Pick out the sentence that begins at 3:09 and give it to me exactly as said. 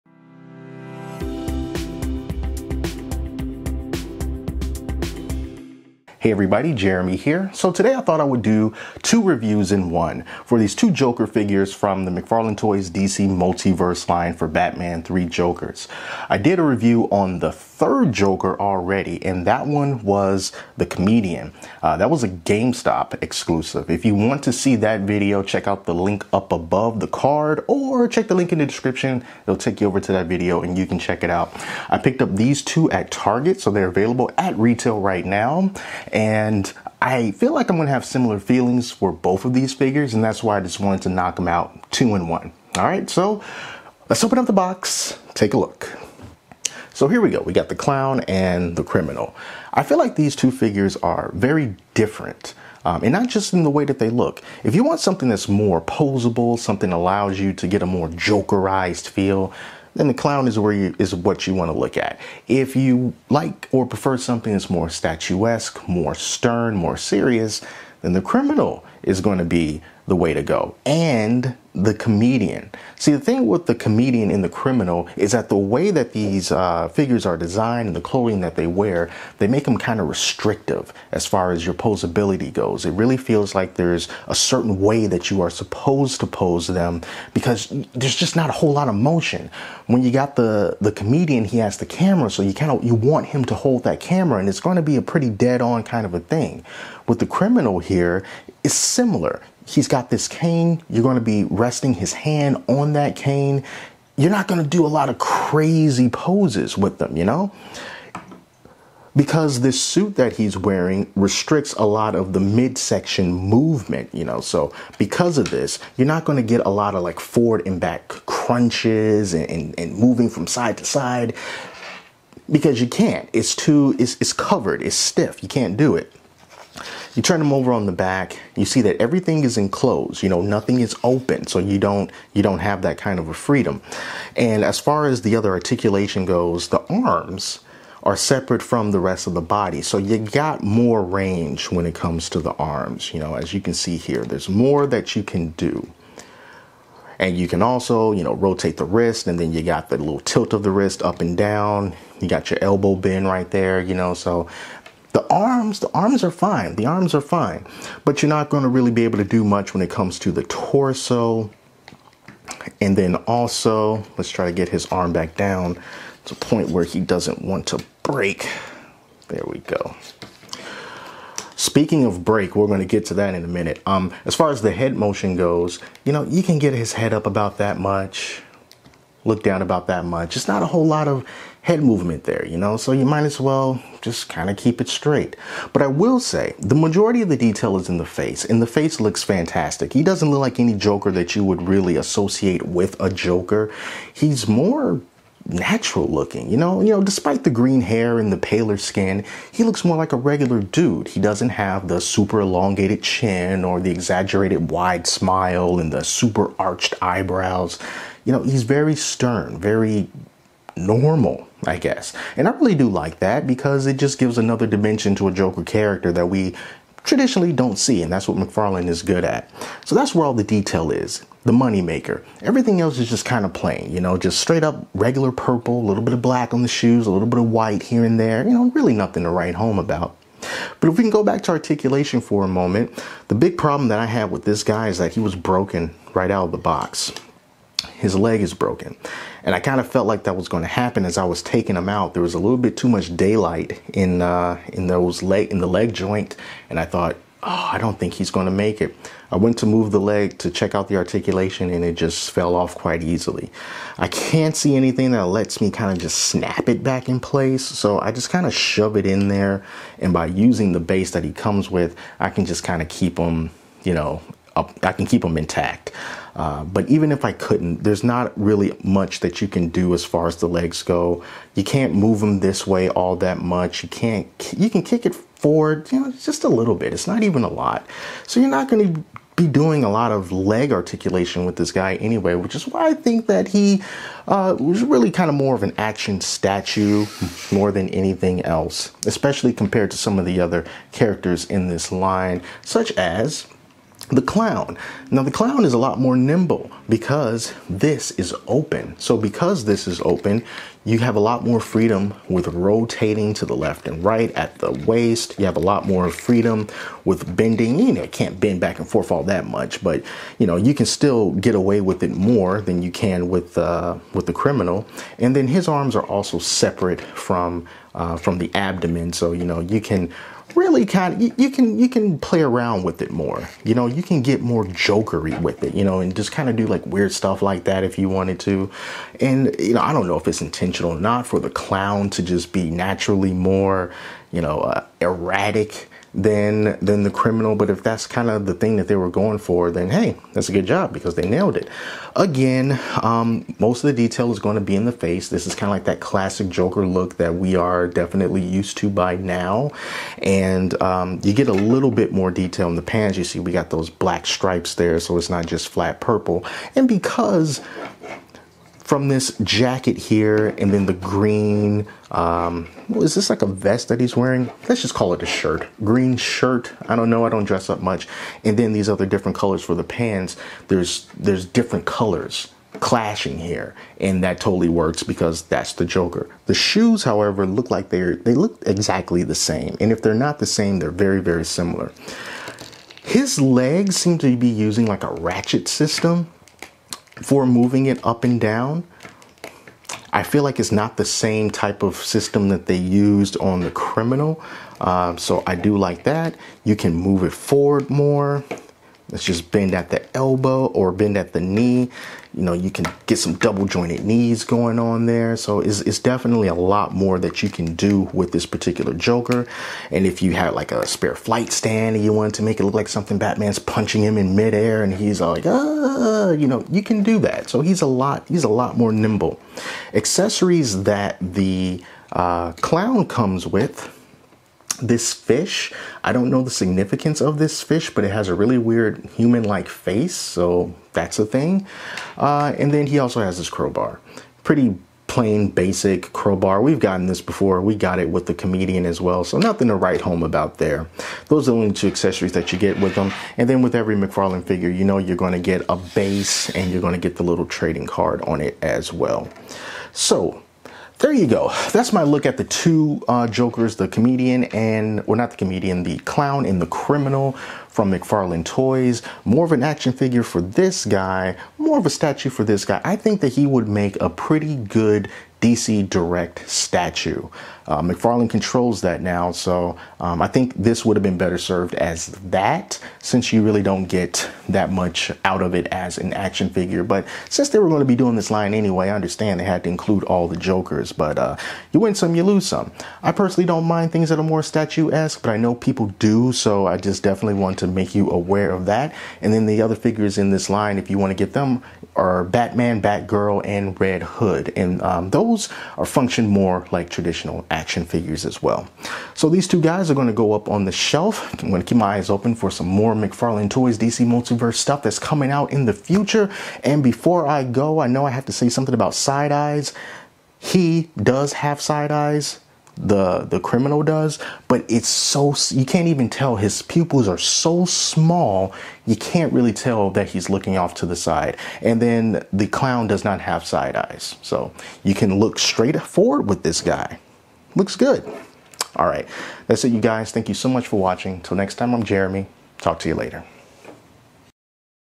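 He doesn't look like any Joker that you would really associate with a Joker.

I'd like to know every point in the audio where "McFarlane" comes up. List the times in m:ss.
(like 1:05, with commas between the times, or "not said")
0:12, 3:38, 7:23, 7:37, 7:47, 8:22.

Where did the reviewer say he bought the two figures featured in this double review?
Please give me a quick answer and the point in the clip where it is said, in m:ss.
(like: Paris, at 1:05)
Target, at 0:33.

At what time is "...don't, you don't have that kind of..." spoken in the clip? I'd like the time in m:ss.
2:11.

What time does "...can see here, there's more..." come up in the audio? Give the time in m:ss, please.
2:23.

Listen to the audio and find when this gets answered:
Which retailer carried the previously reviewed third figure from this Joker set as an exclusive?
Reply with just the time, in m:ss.
0:22.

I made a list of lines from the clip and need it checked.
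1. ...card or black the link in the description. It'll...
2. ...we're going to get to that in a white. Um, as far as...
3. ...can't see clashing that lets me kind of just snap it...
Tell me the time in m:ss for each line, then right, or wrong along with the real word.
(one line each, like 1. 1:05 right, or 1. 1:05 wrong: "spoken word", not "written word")
1. 0:27 wrong: "check", not "black"
2. 2:52 wrong: "minute", not "white"
3. 4:14 wrong: "anything", not "clashing".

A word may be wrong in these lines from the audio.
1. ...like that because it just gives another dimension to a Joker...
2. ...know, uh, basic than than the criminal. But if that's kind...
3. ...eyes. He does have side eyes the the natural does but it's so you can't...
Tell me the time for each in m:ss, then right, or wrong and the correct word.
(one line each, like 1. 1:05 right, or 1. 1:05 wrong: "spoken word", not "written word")
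1. 3:32 right
2. 5:34 wrong: "erratic", not "basic"
3. 8:29 wrong: "criminal", not "natural".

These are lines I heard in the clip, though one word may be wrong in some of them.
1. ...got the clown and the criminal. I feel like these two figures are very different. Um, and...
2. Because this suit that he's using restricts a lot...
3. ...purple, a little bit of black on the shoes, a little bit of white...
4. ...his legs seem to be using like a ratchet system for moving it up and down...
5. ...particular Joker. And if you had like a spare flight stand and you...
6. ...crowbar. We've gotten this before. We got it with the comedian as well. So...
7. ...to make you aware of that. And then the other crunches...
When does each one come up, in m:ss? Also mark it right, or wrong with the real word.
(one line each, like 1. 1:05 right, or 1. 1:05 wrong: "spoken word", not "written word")
1. 0:47 right
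2. 1:49 wrong: "wearing", not "using"
3. 3:45 right
4. 6:23 right
5. 6:48 right
6. 7:16 right
7. 8:07 wrong: "figures", not "crunches".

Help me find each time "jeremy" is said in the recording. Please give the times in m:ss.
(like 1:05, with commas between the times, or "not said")
0:06, 8:51.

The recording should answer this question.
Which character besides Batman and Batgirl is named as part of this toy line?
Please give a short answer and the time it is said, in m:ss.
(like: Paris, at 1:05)
Red Hood, at 8:13.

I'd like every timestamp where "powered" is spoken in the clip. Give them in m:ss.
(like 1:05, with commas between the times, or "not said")
not said.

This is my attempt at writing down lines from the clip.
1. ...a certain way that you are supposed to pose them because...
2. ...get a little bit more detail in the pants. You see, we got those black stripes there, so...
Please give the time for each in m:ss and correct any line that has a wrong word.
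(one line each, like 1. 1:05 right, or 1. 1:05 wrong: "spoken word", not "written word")
1. 1:24 right
2. 5:51 right.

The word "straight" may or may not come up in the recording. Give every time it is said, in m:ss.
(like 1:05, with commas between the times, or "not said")
3:04, 3:44, 8:45.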